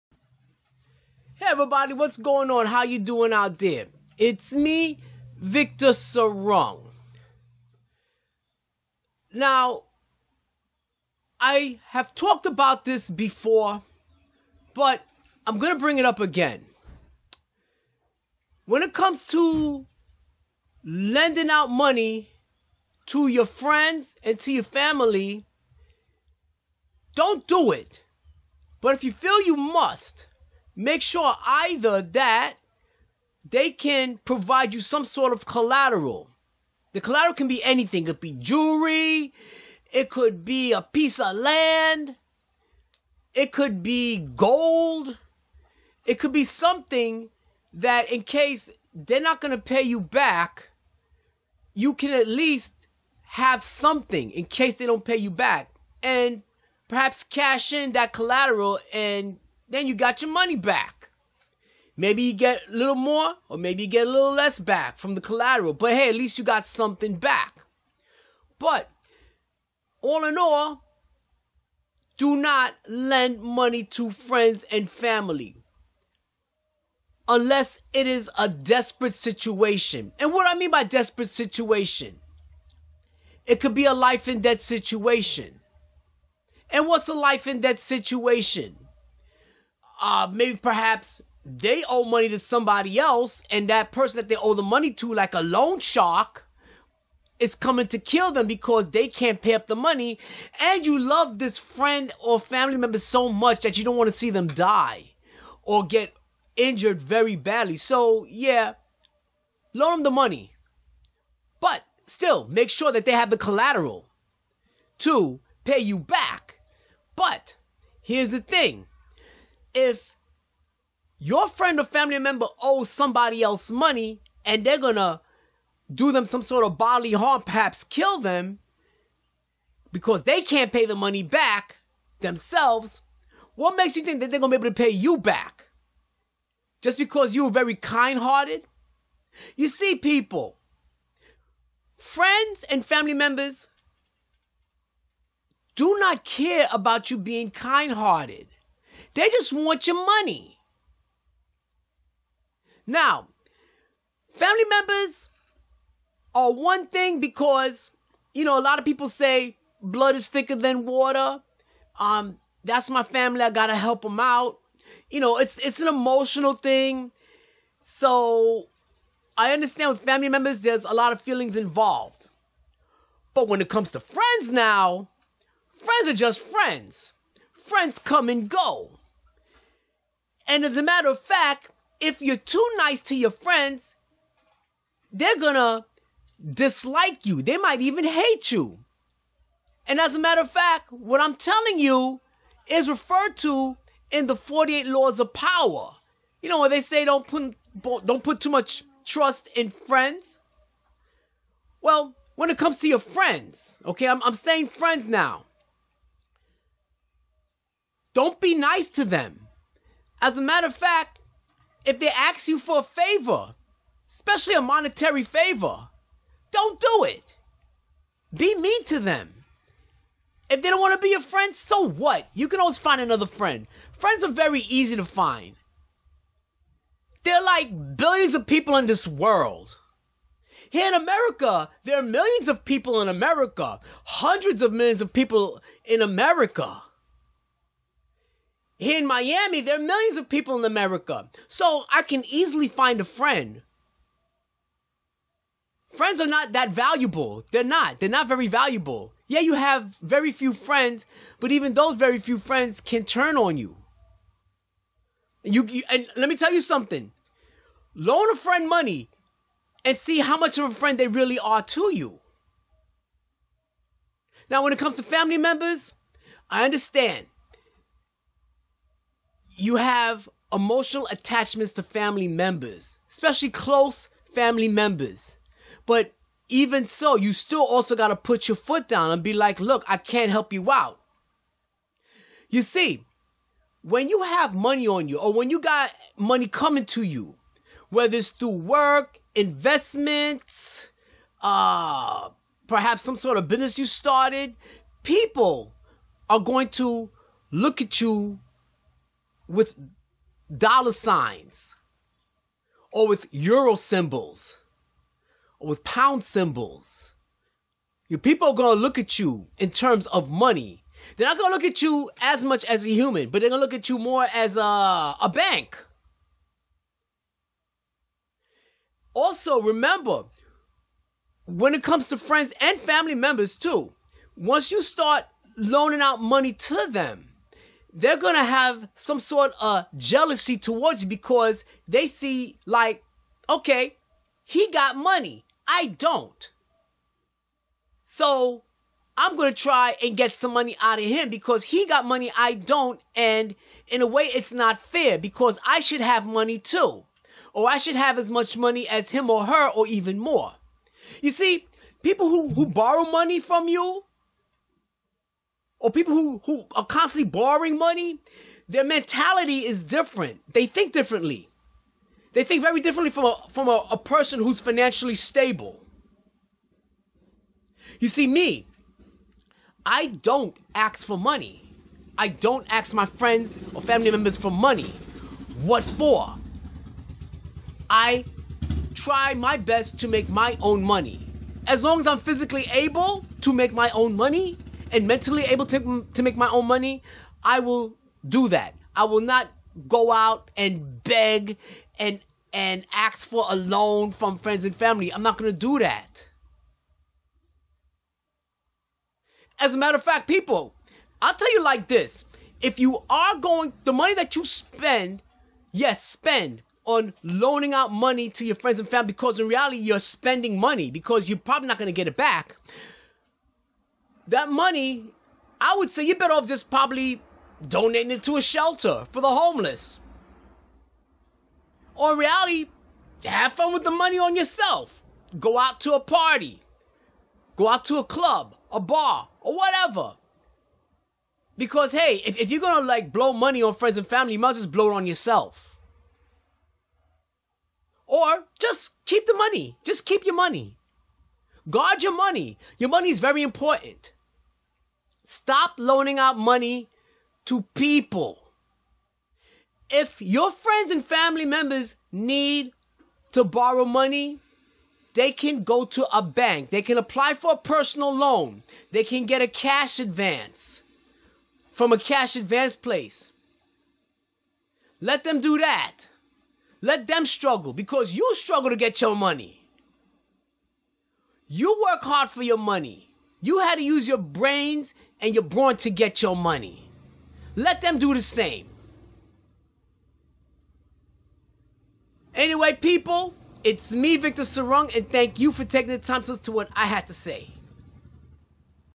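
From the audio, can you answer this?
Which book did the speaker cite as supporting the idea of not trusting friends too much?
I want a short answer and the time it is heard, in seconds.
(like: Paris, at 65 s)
The 48 Laws of Power, at 194 s.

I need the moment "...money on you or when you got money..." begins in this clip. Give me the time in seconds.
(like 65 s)
284 s.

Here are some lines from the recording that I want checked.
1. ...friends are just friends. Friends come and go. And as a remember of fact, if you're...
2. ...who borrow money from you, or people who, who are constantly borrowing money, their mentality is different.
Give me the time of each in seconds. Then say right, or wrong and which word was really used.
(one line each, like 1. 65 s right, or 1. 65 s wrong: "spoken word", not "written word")
1. 175 s wrong: "matter", not "remember"
2. 352 s right.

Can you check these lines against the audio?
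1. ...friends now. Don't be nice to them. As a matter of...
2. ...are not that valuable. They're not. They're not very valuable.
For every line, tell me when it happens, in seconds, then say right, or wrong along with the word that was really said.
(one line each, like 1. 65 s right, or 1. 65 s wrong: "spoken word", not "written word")
1. 204 s right
2. 246 s right.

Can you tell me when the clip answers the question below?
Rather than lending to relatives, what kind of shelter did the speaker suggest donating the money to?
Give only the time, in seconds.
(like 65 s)
418 s.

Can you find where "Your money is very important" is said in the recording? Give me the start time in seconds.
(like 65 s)
442 s.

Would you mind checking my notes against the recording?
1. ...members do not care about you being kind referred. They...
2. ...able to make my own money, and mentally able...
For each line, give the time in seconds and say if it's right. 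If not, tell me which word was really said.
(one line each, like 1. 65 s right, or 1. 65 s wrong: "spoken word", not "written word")
1. 143 s wrong: "hearted", not "referred"
2. 382 s right.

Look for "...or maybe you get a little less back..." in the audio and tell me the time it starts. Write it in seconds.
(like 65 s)
63 s.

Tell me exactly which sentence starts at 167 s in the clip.
So I understand with family members, there's a lot of feelings involved.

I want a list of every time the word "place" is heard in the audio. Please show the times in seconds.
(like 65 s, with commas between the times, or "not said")
462 s.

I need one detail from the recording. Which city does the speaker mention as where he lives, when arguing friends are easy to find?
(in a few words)
Miami.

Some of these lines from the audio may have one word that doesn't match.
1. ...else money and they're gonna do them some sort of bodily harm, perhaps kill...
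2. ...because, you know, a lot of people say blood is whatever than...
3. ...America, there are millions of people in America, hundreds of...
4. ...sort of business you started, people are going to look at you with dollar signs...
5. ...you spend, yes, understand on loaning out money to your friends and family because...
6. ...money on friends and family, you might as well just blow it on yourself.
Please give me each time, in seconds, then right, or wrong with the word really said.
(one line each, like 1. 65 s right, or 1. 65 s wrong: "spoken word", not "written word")
1. 123 s right
2. 157 s wrong: "thicker", not "whatever"
3. 230 s right
4. 293 s right
5. 404 s wrong: "spend", not "understand"
6. 433 s right.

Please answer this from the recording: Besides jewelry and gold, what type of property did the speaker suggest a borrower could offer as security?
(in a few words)
A piece of land.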